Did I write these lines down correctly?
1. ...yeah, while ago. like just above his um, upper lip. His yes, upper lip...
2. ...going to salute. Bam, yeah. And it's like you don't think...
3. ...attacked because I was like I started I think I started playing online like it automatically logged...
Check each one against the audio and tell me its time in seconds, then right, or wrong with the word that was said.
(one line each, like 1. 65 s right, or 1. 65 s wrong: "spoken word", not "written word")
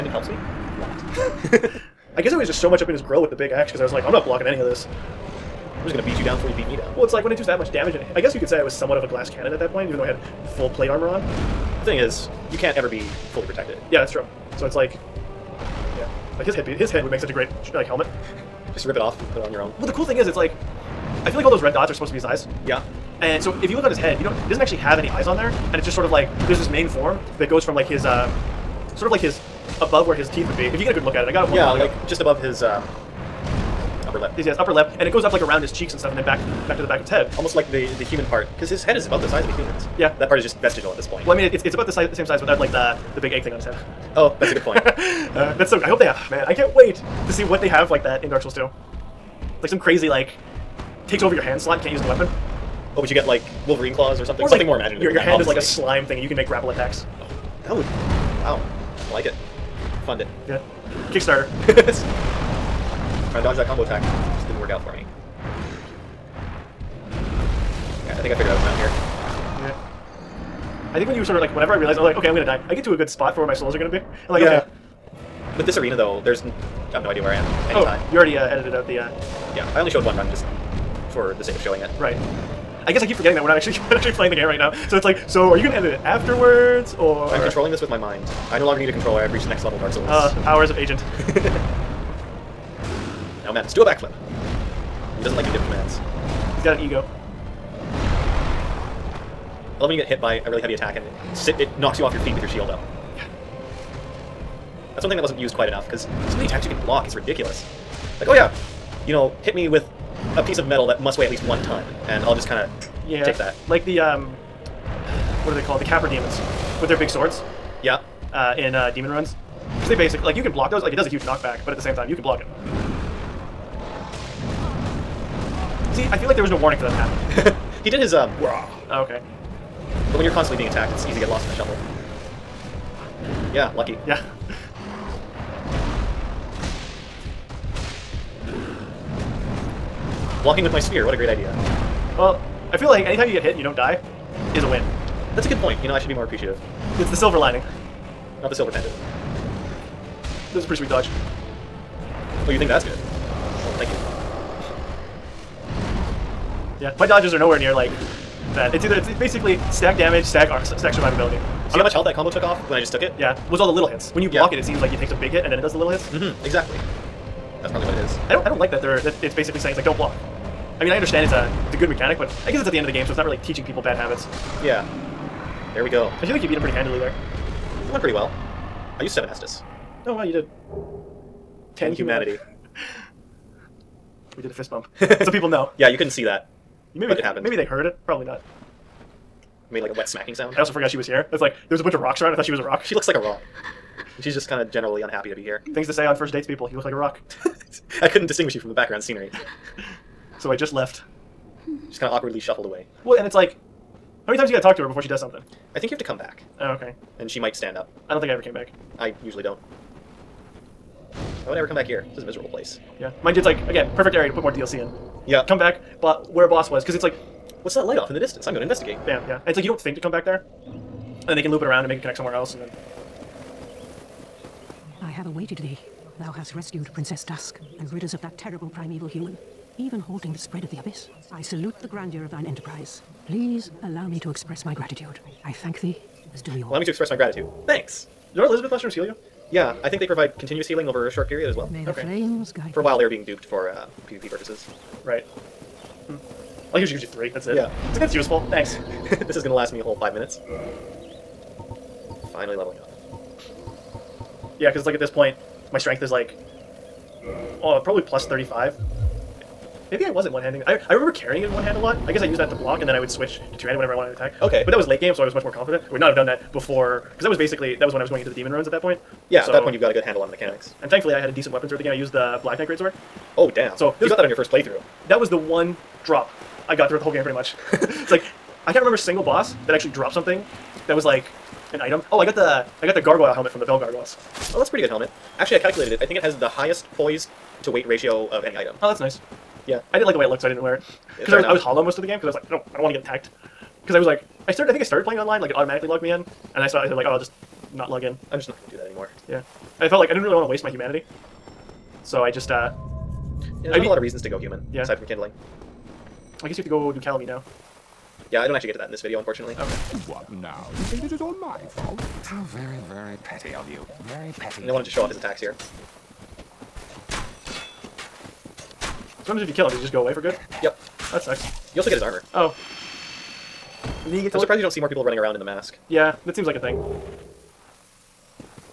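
1. 31 s right
2. 218 s wrong: "investigate", not "salute"
3. 292 s right.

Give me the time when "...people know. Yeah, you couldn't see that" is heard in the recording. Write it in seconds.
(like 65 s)
185 s.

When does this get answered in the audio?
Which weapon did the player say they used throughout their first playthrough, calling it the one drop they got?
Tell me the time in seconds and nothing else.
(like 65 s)
272 s.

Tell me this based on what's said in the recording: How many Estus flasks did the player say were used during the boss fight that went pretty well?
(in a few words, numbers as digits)
7.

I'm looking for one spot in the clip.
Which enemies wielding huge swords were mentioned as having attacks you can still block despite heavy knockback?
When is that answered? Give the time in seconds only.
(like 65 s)
115 s.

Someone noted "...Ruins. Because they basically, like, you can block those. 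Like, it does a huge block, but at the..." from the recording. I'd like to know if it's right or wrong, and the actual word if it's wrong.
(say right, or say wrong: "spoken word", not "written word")
wrong: "knockback", not "block".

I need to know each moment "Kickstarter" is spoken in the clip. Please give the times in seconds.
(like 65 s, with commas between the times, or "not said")
61 s.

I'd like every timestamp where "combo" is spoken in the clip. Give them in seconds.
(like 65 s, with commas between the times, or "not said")
63 s, 162 s.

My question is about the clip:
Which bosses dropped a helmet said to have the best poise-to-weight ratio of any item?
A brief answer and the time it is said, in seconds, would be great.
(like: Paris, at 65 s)
Bell Gargoyles, at 283 s.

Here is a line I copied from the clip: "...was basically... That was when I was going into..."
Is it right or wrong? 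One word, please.
right.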